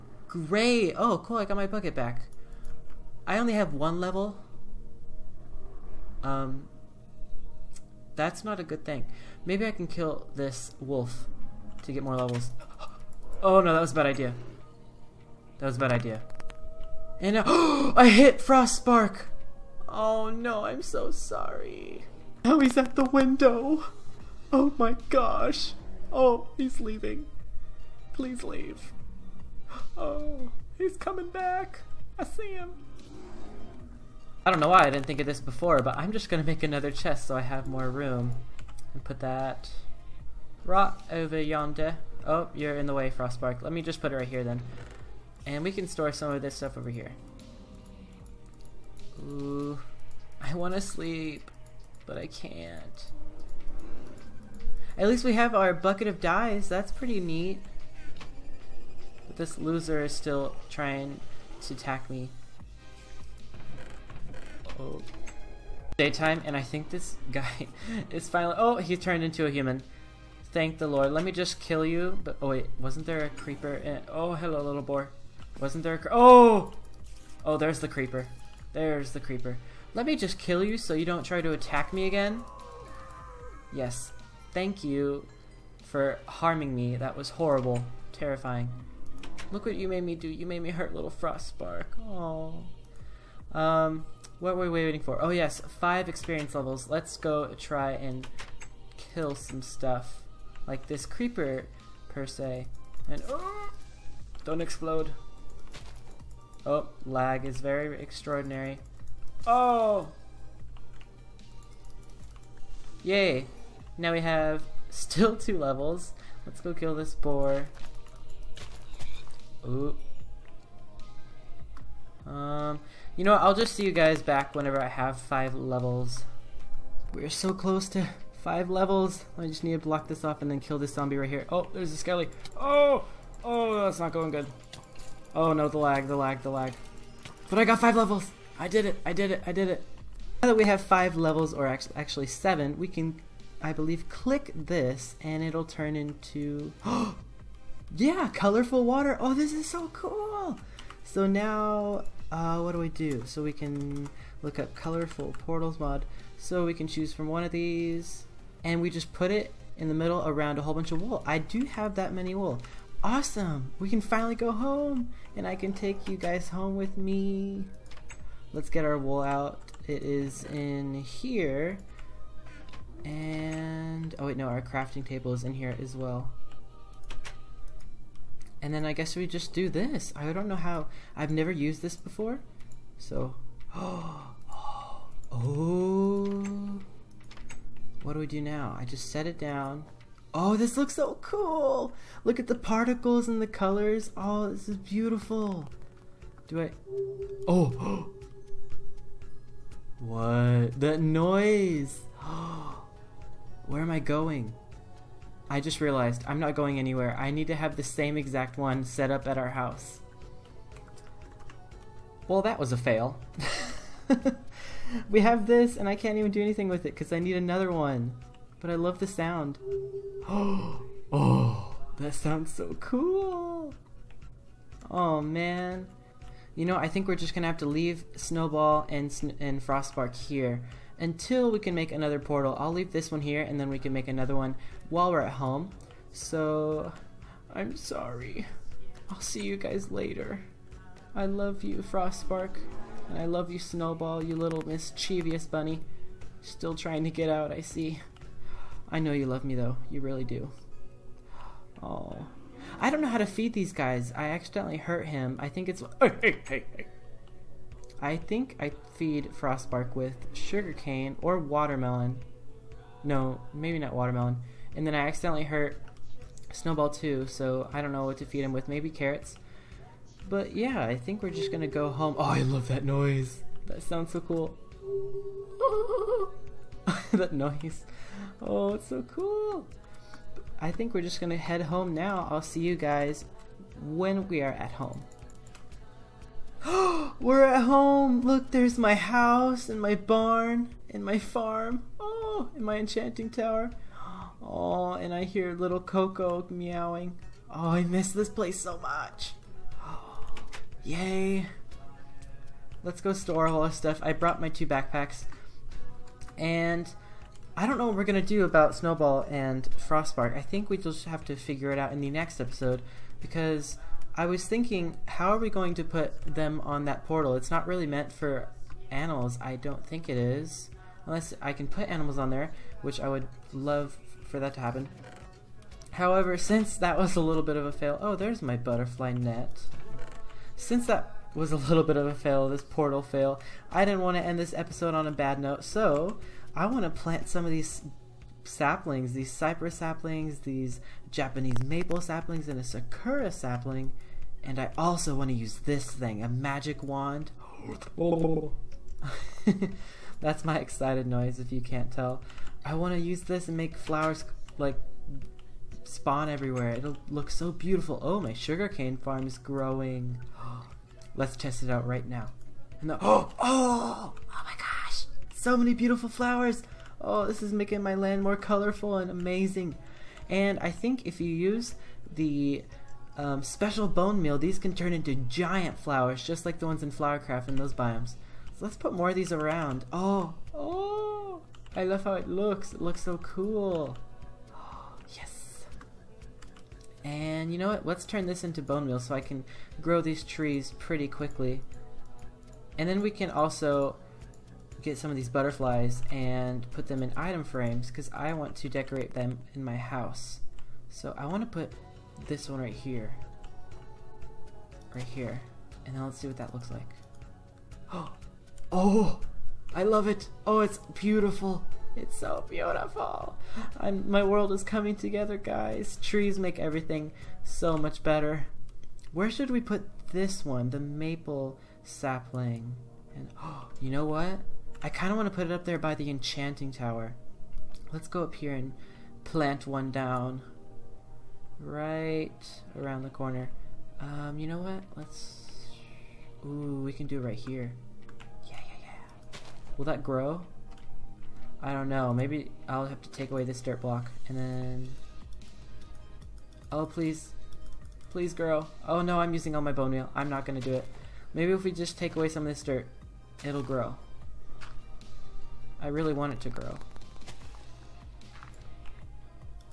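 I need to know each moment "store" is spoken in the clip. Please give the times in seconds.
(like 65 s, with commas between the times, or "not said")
45 s, 303 s.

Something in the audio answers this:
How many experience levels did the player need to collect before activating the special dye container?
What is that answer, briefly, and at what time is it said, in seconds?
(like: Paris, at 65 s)
5, at 95 s.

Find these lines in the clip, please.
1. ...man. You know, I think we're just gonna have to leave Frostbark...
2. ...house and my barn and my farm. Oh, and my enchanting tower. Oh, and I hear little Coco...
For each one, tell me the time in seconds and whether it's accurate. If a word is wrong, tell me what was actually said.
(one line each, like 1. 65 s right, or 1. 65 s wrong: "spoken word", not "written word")
1. 225 s wrong: "Snowball", not "Frostbark"
2. 288 s right.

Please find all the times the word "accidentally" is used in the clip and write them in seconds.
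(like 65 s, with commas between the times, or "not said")
254 s, 265 s.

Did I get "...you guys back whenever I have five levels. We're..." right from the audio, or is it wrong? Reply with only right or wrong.
right.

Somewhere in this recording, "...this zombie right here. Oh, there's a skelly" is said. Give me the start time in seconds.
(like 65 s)
130 s.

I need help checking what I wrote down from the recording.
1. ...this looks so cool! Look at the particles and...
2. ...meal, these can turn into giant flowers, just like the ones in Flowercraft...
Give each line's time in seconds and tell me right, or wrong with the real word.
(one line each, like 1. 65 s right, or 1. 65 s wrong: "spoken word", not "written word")
1. 190 s right
2. 374 s right.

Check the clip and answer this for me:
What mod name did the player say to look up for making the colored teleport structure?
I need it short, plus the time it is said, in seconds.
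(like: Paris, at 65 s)
Colorful portals mod, at 154 s.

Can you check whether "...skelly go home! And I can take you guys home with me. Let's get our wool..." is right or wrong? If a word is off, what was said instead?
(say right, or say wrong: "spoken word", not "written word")
wrong: "finally", not "skelly".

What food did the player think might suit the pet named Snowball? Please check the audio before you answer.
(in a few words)
Carrots.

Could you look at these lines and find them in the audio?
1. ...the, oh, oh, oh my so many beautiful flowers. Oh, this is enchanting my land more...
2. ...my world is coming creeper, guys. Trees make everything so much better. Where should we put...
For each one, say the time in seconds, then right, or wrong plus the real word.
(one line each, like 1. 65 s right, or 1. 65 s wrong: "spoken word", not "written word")
1. 362 s wrong: "making", not "enchanting"
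2. 414 s wrong: "together", not "creeper".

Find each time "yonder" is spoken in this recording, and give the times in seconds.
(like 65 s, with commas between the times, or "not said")
41 s.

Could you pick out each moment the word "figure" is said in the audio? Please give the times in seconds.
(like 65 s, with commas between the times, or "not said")
311 s.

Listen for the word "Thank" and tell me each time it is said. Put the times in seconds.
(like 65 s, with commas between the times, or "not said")
70 s, 84 s.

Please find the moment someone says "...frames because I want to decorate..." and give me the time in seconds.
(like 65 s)
397 s.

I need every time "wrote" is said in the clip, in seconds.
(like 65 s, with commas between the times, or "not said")
not said.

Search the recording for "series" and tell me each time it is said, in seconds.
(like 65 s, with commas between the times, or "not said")
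not said.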